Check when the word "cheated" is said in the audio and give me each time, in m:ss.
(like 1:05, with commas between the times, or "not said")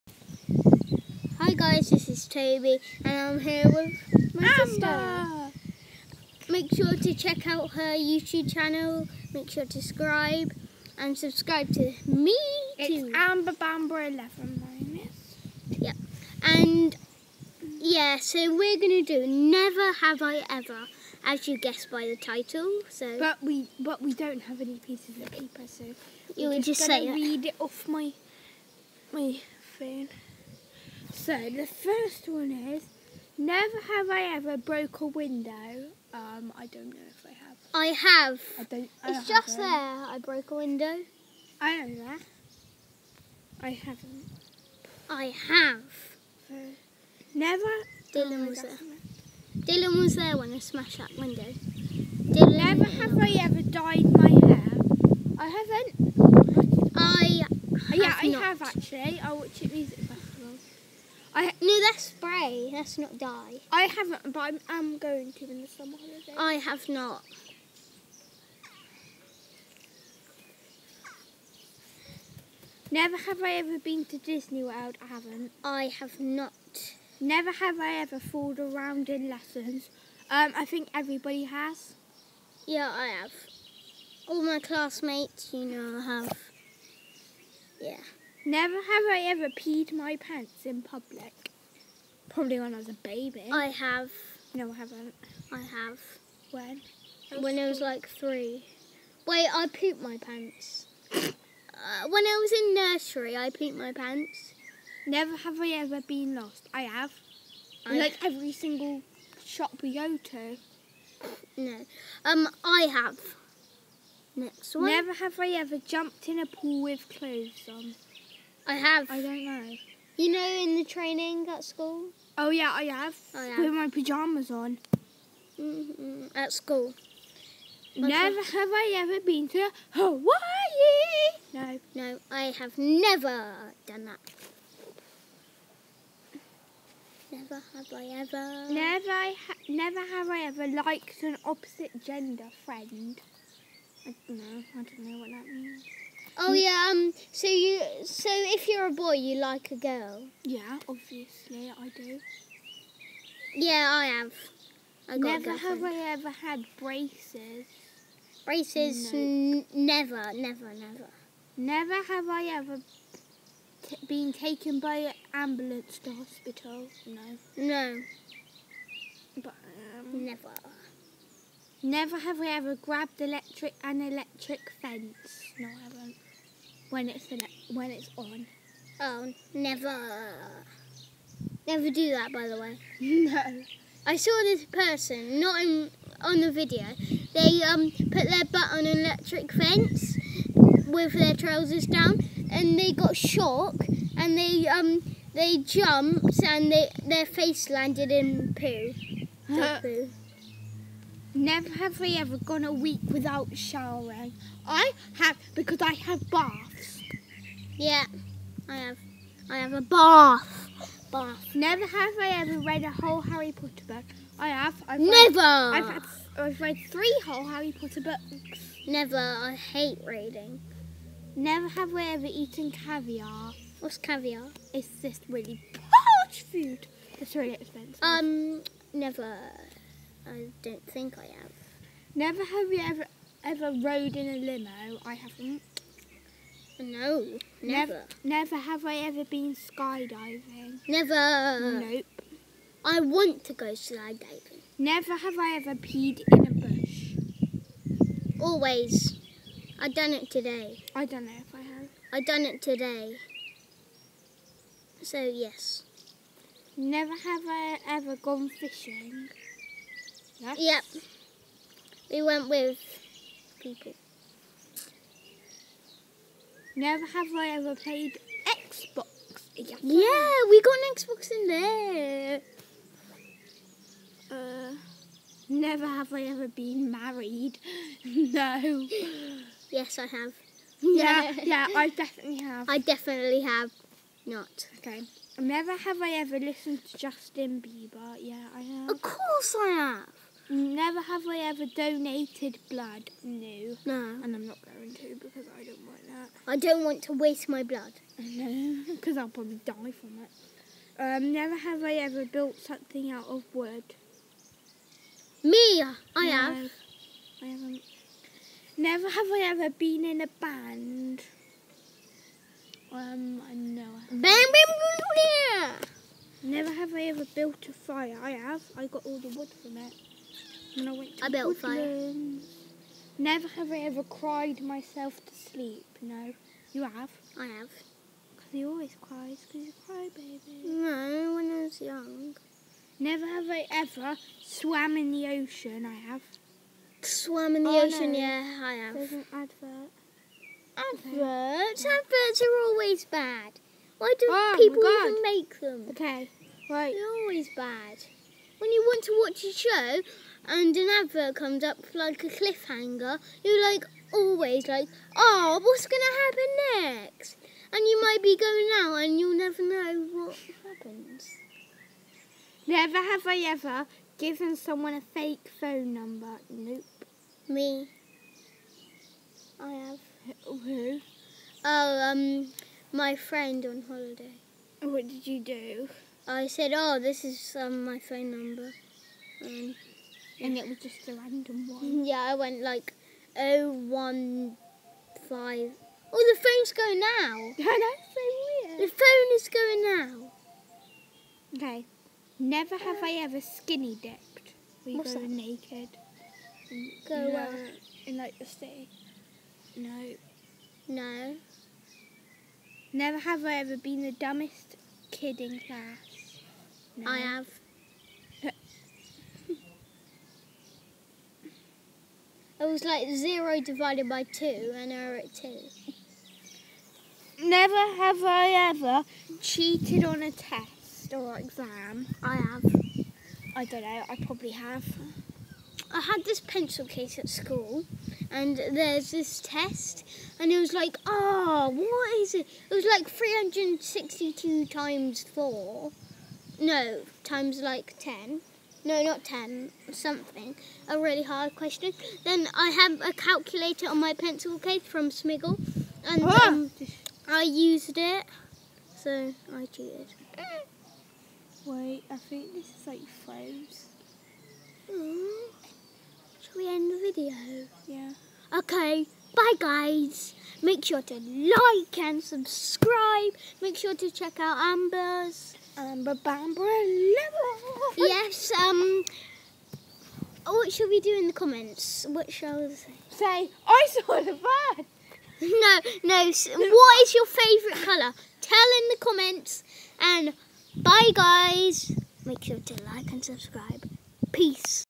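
6:59, 7:29.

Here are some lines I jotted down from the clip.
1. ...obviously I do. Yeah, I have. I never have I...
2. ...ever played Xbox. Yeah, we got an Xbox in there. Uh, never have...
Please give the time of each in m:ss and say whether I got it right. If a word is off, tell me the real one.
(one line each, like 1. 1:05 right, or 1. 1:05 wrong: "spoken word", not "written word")
1. 2:30 right
2. 4:27 right.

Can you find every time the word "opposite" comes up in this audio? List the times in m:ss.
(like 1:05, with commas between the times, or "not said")
2:21.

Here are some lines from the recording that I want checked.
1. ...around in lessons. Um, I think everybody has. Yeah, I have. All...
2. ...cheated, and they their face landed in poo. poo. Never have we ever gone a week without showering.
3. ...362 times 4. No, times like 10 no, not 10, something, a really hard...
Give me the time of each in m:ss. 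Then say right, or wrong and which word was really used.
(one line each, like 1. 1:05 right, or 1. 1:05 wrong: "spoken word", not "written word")
1. 1:18 right
2. 3:15 wrong: "jumped", not "cheated"
3. 7:13 right.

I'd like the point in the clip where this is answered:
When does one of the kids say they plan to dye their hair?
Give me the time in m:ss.
1:05.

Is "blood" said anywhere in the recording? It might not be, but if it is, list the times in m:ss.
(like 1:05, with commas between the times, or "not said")
4:52, 4:57.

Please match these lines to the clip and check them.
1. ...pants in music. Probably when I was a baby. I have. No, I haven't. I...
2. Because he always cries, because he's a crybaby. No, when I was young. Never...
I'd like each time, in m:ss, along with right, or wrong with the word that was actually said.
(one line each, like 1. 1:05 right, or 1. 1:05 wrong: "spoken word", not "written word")
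1. 1:30 wrong: "public", not "music"
2. 5:28 right.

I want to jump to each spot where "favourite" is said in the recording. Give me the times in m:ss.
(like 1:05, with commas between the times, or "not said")
7:57.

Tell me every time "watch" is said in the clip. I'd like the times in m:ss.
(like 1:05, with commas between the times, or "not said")
0:59, 5:49.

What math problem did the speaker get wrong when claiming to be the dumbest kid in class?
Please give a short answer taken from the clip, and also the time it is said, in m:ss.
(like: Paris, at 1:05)
0 divided by 2, at 6:53.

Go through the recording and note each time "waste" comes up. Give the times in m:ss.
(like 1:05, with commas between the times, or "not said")
4:57.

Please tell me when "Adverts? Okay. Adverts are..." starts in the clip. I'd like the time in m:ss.
5:40.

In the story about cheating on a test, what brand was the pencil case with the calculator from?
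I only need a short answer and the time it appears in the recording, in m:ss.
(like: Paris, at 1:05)
Smiggle, at 7:25.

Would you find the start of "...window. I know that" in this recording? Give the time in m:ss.
0:40.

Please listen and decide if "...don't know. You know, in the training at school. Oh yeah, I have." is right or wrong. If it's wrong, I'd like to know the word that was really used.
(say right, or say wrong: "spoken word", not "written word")
right.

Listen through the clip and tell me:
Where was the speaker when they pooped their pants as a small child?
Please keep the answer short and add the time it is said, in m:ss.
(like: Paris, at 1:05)
nursery, at 1:42.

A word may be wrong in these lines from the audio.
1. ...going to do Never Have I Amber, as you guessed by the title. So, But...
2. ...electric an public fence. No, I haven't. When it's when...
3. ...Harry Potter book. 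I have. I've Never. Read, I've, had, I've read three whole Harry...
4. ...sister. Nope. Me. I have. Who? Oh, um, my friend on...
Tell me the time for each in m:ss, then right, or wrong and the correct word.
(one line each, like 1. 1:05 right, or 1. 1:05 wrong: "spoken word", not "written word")
1. 0:18 wrong: "Ever", not "Amber"
2. 2:53 wrong: "electric", not "public"
3. 3:33 right
4. 6:05 wrong: "number", not "sister".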